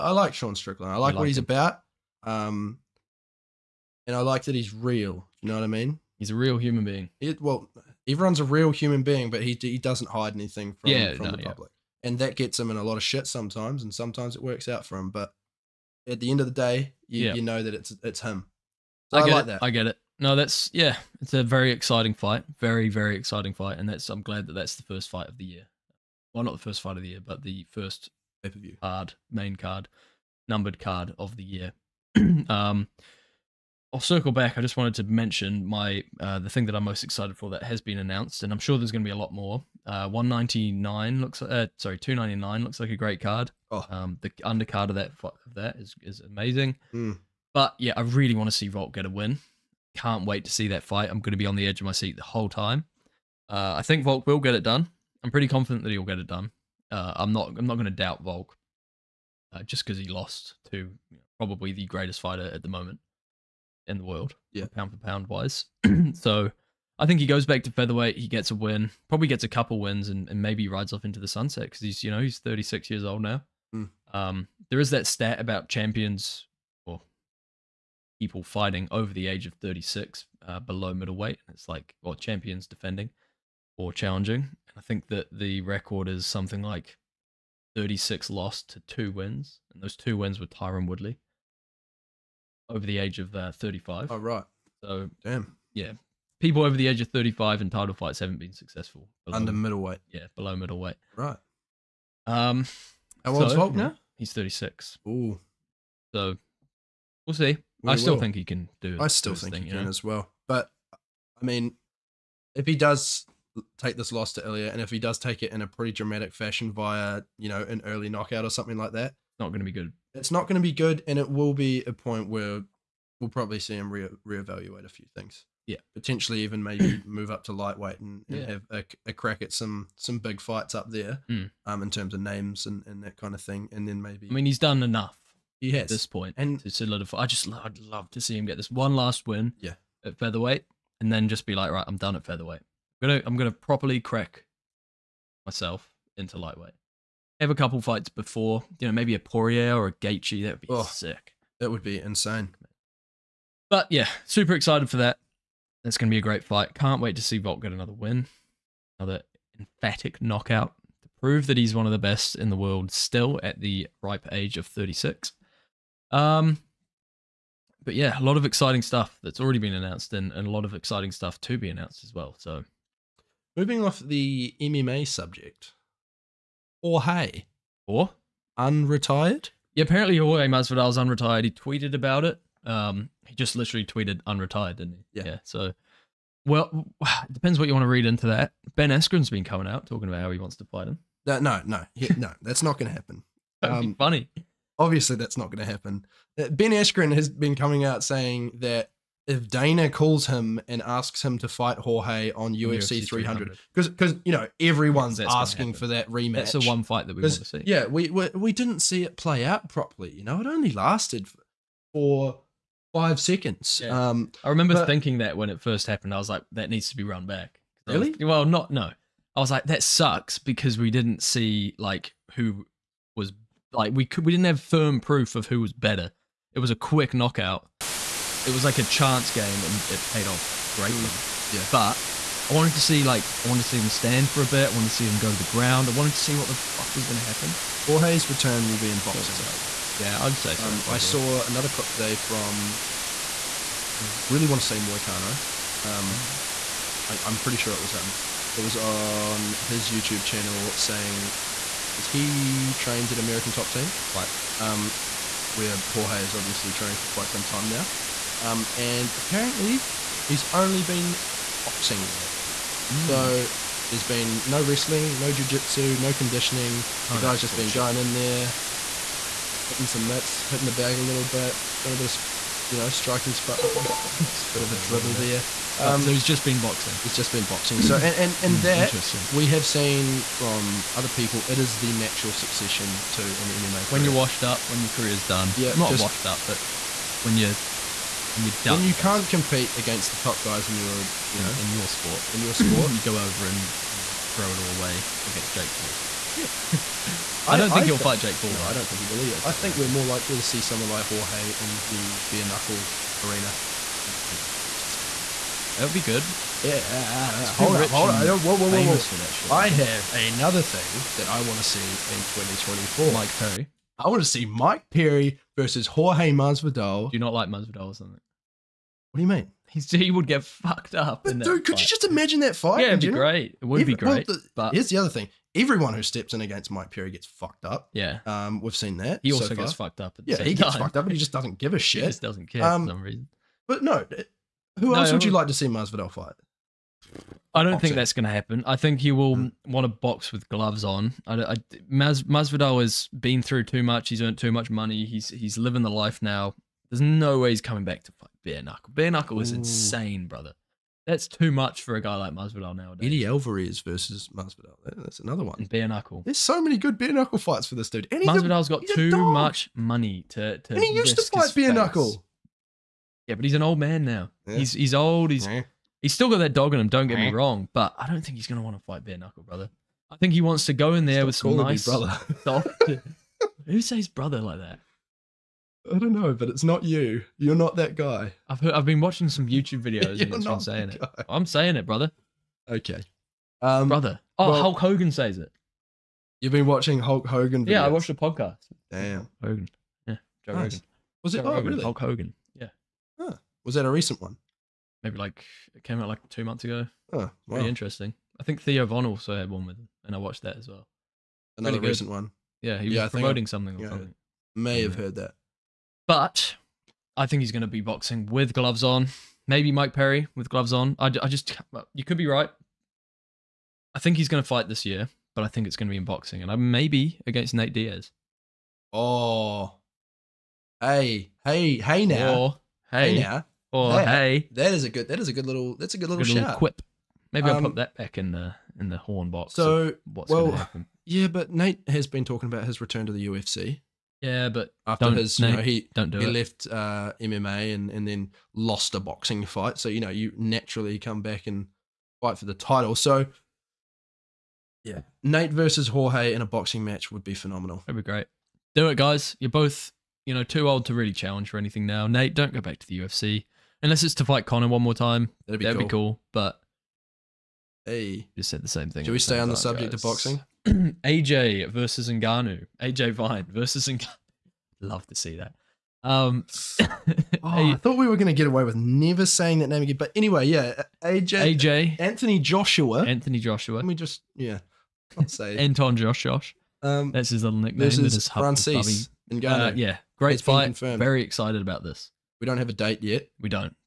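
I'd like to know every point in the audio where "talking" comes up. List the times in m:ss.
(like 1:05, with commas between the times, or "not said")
3:09, 7:12.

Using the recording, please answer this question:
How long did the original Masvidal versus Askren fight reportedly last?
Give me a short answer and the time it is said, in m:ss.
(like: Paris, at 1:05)
5 seconds, at 3:32.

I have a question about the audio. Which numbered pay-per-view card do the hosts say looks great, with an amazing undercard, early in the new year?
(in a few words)
299.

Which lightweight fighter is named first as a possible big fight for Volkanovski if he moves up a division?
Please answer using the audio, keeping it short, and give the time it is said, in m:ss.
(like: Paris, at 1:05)
Poirier, at 2:29.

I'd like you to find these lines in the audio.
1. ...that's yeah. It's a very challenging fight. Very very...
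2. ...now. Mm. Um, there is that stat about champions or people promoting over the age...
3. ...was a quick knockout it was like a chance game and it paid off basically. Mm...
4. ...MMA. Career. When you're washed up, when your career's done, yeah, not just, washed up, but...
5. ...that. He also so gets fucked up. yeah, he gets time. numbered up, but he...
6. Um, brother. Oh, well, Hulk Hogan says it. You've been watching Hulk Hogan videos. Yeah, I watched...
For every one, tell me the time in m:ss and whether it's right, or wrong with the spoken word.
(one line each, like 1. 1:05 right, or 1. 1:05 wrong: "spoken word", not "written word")
1. 0:20 wrong: "exciting", not "challenging"
2. 1:13 wrong: "fighting", not "promoting"
3. 3:46 wrong: "greatly", not "basically"
4. 4:43 right
5. 5:28 wrong: "fucked", not "numbered"
6. 6:23 right.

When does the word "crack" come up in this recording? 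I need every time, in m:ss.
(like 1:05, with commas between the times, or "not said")
2:09, 2:23.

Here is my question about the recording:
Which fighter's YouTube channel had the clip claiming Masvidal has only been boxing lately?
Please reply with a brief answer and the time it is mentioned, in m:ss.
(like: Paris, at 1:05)
Moicano, at 4:04.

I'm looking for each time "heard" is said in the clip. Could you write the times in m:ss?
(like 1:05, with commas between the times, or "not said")
6:18, 6:44.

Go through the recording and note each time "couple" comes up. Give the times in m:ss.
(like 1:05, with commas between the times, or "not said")
1:09, 2:27.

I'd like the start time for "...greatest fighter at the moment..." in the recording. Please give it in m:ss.
1:01.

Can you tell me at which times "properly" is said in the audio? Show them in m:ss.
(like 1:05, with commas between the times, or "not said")
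2:23, 3:29.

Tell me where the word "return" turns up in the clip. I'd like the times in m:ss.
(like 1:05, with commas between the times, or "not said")
3:58, 7:12.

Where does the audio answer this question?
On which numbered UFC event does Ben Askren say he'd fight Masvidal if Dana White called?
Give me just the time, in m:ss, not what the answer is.
3:23.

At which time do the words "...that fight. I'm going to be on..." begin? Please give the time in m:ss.
0:50.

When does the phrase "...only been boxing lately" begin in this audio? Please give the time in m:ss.
4:20.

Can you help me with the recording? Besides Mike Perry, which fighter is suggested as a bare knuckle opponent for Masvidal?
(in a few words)
Eddie Alvarez.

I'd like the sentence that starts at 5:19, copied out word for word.
He's, he would get fucked up.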